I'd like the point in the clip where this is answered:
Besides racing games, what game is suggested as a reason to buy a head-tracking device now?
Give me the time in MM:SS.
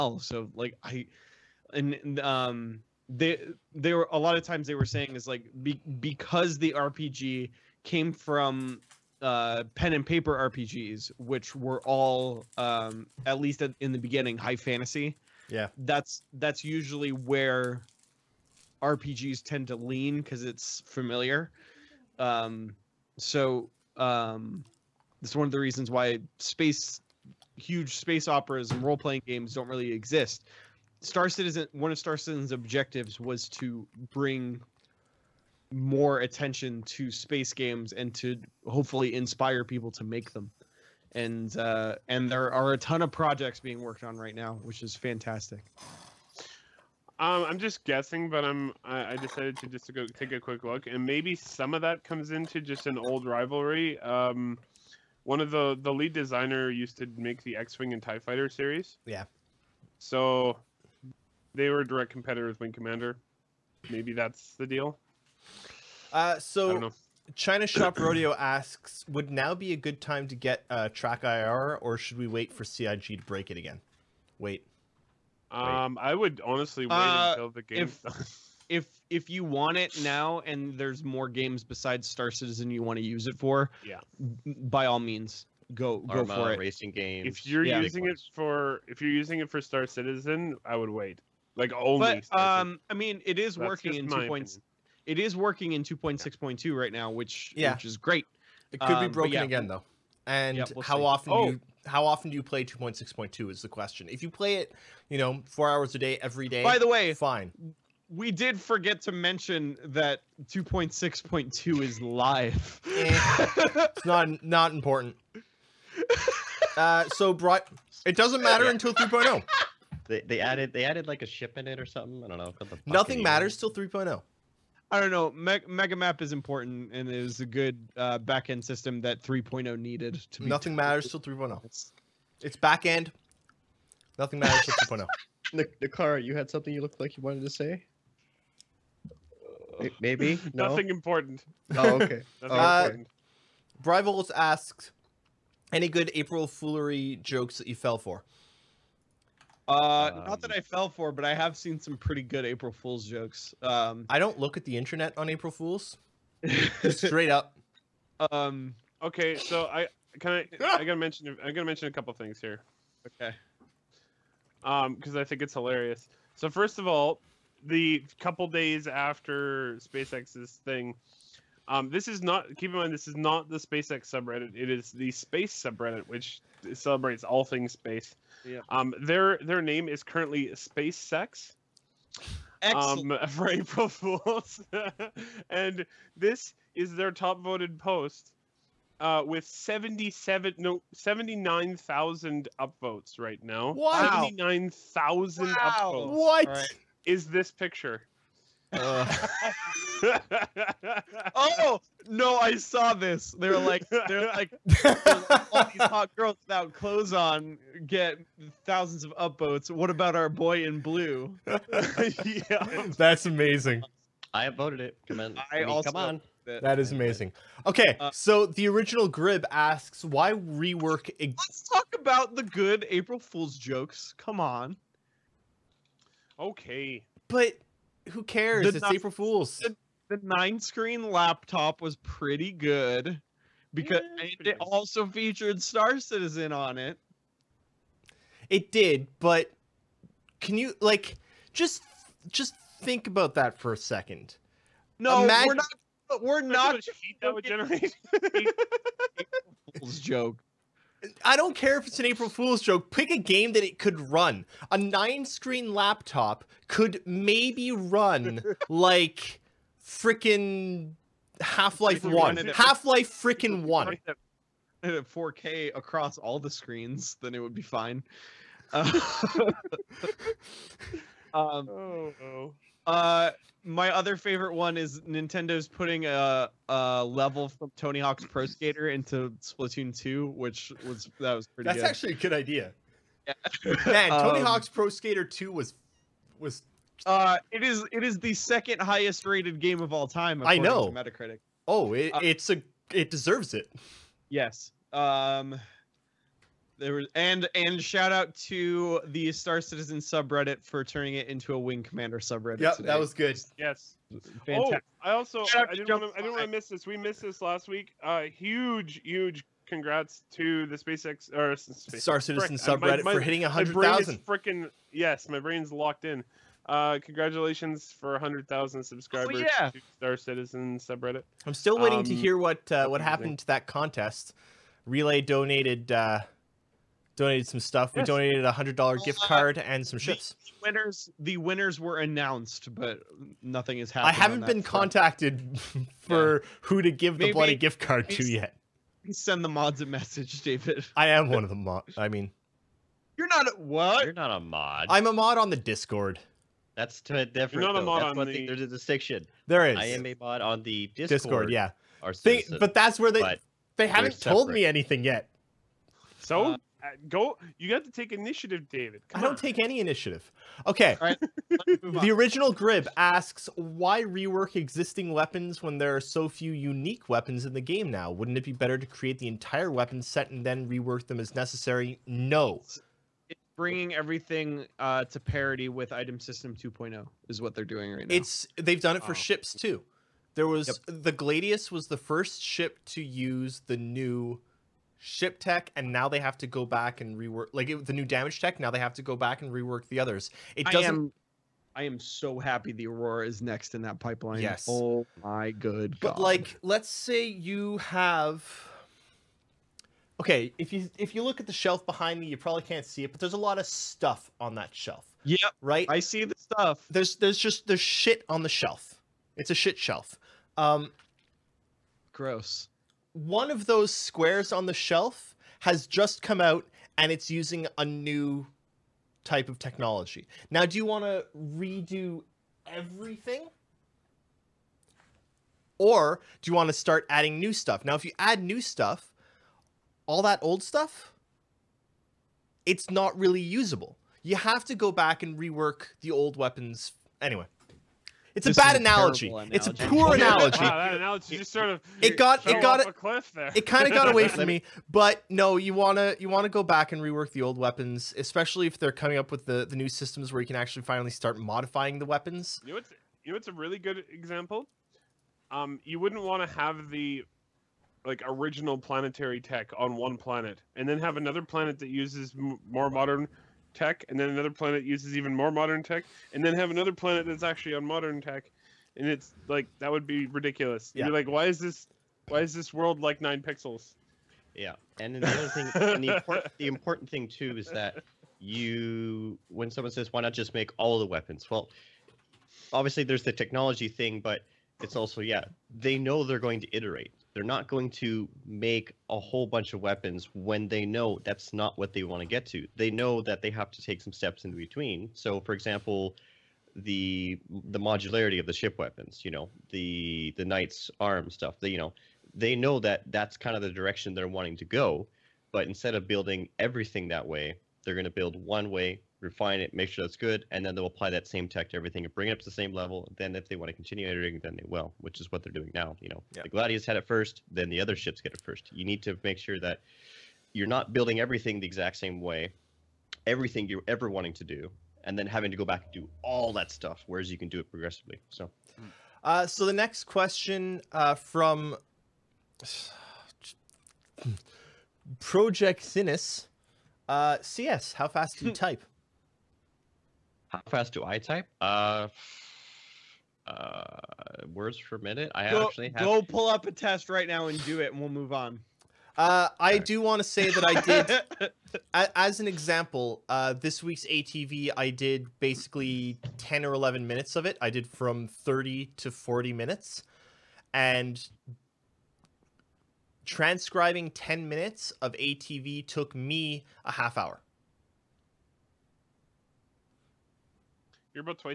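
01:26.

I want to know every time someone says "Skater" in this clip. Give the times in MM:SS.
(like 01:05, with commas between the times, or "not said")
04:38, 04:44.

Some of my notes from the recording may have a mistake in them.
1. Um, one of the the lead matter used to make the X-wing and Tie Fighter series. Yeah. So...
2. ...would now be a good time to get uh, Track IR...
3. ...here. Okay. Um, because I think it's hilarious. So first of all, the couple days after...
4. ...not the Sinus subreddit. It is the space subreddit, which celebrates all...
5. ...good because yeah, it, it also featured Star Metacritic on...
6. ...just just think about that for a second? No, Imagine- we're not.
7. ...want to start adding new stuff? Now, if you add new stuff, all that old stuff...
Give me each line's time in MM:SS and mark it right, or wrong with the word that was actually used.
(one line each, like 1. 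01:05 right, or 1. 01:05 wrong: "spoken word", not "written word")
1. 00:53 wrong: "designer", not "matter"
2. 01:09 right
3. 02:42 right
4. 02:53 wrong: "SpaceX", not "Sinus"
5. 03:52 wrong: "Citizen", not "Metacritic"
6. 04:01 right
7. 07:06 right.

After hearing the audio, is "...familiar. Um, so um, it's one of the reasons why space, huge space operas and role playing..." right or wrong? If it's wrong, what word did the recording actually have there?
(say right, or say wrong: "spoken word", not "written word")
right.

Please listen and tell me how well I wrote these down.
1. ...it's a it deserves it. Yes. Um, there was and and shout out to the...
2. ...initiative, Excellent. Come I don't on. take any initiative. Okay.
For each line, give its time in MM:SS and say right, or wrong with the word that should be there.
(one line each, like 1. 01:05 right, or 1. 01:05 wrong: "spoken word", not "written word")
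1. 04:52 right
2. 05:58 wrong: "David", not "Excellent".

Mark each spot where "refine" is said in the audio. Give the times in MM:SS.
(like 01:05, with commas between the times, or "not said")
08:29.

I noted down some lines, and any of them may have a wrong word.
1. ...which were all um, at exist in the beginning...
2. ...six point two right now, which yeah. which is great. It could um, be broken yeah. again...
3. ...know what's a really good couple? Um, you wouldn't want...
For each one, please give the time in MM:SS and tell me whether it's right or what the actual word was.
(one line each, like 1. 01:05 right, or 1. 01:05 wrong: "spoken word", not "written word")
1. 00:11 wrong: "least", not "exist"
2. 01:36 right
3. 07:33 wrong: "example", not "couple".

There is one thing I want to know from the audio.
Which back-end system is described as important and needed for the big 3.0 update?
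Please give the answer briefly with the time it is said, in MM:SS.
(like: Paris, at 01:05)
Mega Map, at 02:05.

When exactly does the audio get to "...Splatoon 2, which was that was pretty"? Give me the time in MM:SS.
04:39.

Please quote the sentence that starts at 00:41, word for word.
And uh, and there are a ton of projects being worked on right now, which is fantastic.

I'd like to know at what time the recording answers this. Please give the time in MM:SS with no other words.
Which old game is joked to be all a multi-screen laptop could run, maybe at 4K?
04:21.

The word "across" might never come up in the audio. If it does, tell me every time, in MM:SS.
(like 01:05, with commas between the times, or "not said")
04:25.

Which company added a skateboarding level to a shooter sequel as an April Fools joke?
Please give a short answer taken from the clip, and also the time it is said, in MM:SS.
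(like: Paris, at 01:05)
Nintendo, at 04:35.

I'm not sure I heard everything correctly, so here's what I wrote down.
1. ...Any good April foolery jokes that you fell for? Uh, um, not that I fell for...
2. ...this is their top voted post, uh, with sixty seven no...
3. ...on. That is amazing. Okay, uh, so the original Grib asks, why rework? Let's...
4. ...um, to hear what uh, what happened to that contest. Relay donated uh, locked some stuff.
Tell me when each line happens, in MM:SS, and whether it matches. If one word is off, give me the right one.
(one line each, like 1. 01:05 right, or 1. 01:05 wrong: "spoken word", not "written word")
1. 02:25 right
2. 03:06 wrong: "seventy", not "sixty"
3. 03:36 right
4. 05:21 wrong: "donated", not "locked".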